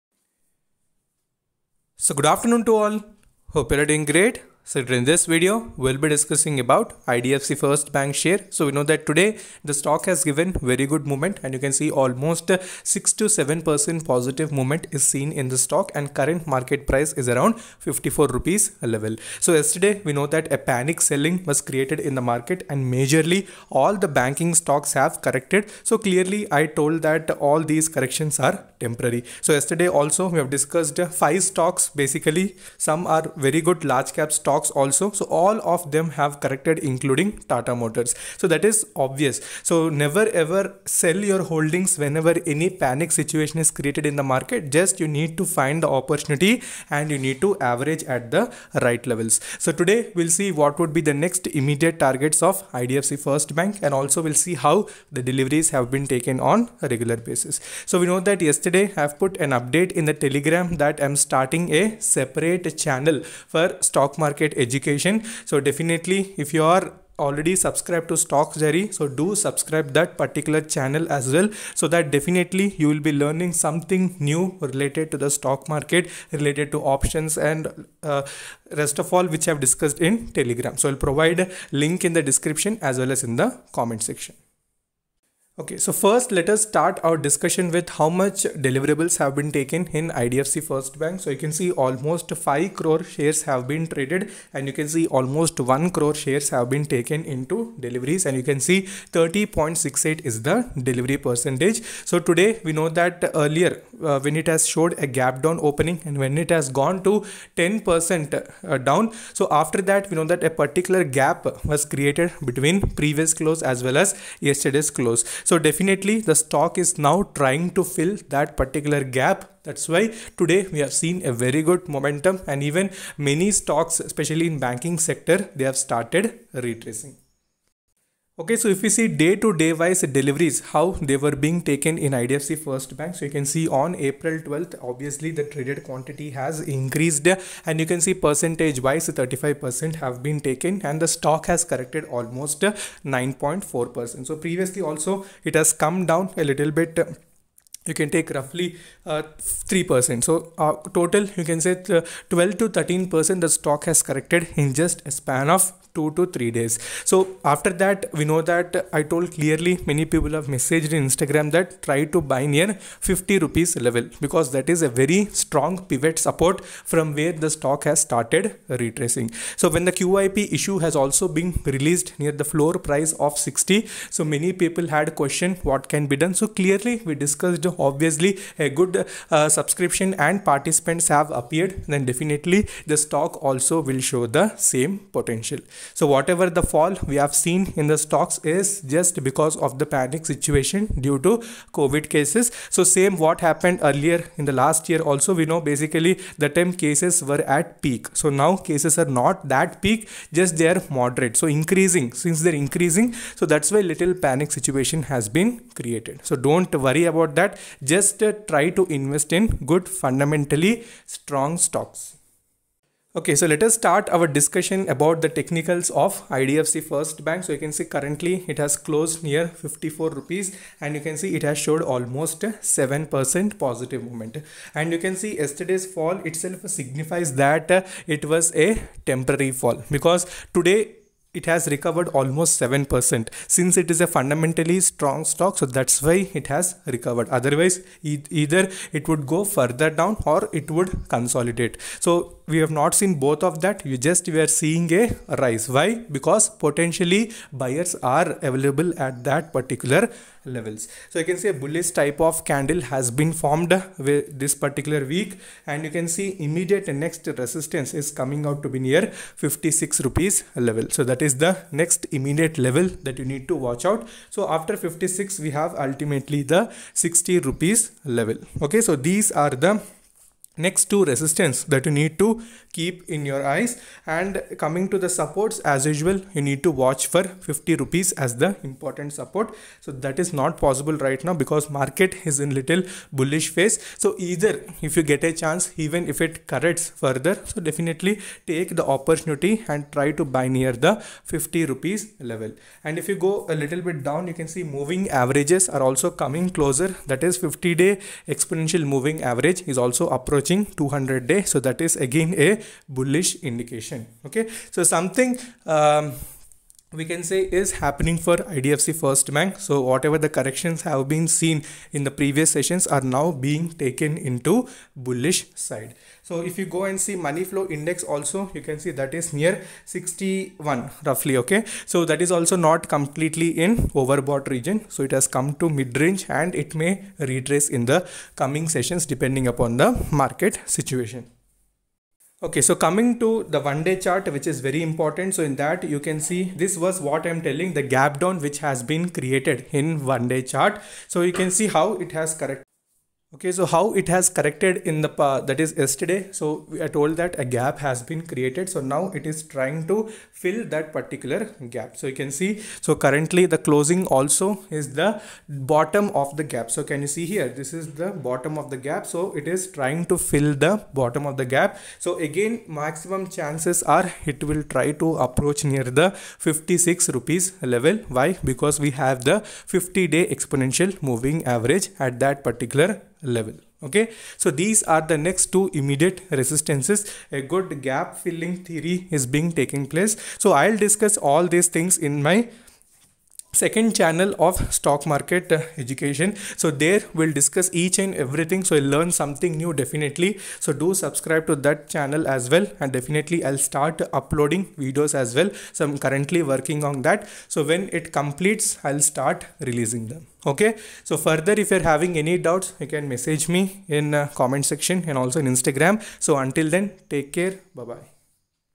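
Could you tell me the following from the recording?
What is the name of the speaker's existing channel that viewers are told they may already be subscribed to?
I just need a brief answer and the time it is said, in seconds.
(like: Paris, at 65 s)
StocksDiary, at 68 s.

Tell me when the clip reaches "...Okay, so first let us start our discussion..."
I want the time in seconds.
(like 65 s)
85 s.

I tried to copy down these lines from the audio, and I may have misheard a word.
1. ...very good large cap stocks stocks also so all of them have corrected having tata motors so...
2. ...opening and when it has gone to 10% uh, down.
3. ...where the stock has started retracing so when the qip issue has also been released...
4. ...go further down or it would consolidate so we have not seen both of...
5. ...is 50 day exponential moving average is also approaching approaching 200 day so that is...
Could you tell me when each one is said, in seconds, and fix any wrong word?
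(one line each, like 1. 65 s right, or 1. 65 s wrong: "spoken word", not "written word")
1. 33 s wrong: "including", not "having"
2. 105 s right
3. 167 s right
4. 239 s right
5. 297 s right.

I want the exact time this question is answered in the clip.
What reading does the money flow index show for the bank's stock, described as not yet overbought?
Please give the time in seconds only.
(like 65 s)
319 s.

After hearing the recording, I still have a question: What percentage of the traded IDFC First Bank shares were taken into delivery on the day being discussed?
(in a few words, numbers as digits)
30.68%.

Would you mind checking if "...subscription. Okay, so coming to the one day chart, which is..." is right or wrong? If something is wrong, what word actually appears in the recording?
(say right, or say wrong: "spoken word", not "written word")
wrong: "situation", not "subscription".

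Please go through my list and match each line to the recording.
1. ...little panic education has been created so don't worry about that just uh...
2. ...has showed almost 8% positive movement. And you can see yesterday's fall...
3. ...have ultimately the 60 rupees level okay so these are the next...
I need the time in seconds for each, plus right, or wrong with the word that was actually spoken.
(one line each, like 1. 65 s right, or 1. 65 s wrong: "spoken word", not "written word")
1. 203 s wrong: "situation", not "education"
2. 221 s wrong: "7", not "8"
3. 265 s right.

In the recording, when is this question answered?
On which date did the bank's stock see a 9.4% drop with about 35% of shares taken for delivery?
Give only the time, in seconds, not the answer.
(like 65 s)
134 s.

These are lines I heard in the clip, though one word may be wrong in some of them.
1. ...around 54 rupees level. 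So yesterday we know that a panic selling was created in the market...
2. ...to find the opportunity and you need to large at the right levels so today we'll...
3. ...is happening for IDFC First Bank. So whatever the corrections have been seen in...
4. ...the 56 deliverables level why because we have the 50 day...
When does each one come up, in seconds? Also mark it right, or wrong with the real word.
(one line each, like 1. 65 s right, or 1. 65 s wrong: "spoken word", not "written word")
1. 17 s right
2. 45 s wrong: "average", not "large"
3. 307 s right
4. 365 s wrong: "rupees", not "deliverables".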